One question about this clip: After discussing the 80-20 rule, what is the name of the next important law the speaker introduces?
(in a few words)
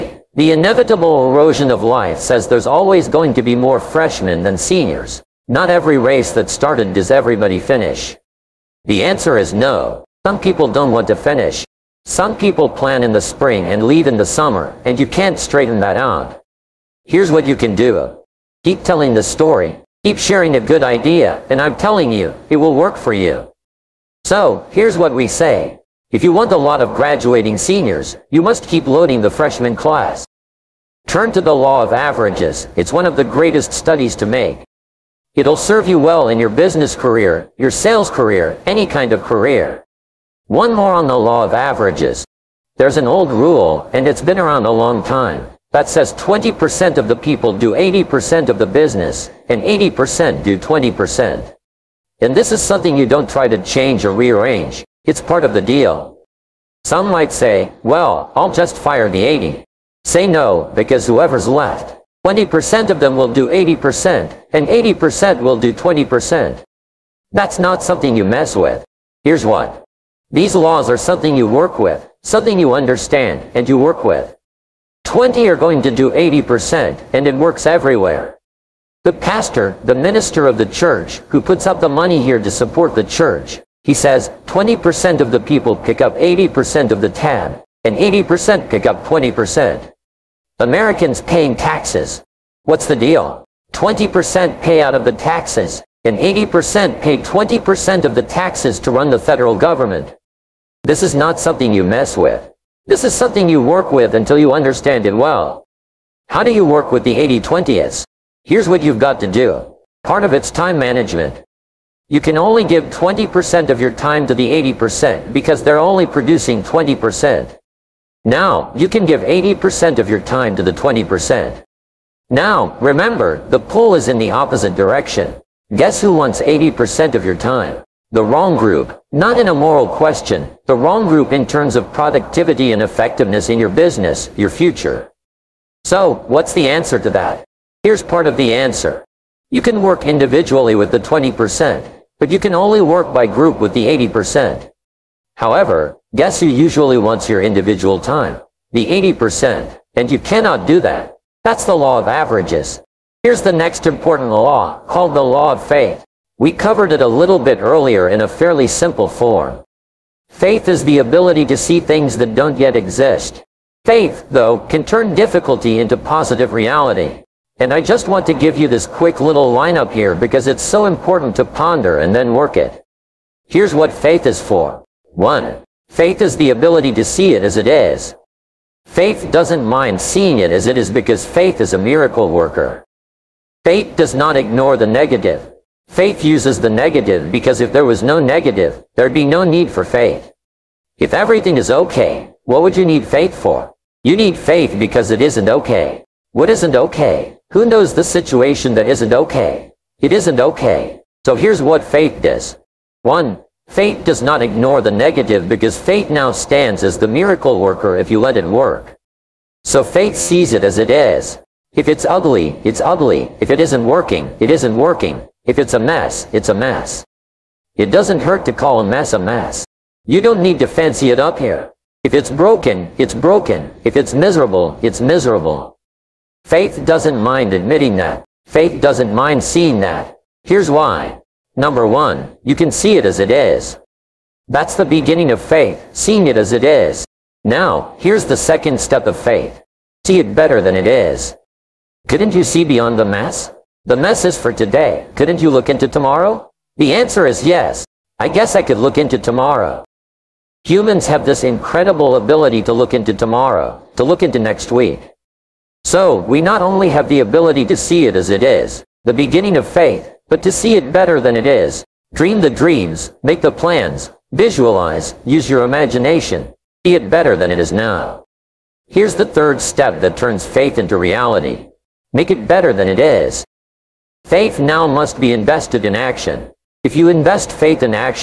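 law of faith.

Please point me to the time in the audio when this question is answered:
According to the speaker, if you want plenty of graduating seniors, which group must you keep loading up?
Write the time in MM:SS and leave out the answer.
00:29.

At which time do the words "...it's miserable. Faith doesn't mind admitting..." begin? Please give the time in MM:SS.
03:44.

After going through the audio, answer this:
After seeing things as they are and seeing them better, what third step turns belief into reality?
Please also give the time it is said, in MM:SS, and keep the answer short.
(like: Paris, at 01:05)
make it better, at 04:32.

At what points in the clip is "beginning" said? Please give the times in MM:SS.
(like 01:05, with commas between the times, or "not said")
03:54, 04:19.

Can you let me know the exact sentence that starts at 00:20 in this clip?
Keep sharing a good idea, and I'm telling you, it will work for you.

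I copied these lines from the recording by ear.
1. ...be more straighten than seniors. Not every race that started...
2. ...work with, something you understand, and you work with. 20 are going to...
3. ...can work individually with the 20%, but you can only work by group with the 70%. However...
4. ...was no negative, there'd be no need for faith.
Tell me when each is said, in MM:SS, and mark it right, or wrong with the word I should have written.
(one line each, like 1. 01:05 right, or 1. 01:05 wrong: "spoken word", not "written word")
1. 00:03 wrong: "freshmen", not "straighten"
2. 01:11 right
3. 02:19 wrong: "80", not "70"
4. 03:07 right.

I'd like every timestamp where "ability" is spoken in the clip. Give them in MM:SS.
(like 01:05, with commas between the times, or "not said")
02:40, 02:56, 04:12, 04:17.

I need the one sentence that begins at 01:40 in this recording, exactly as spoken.
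This is not something you mess with.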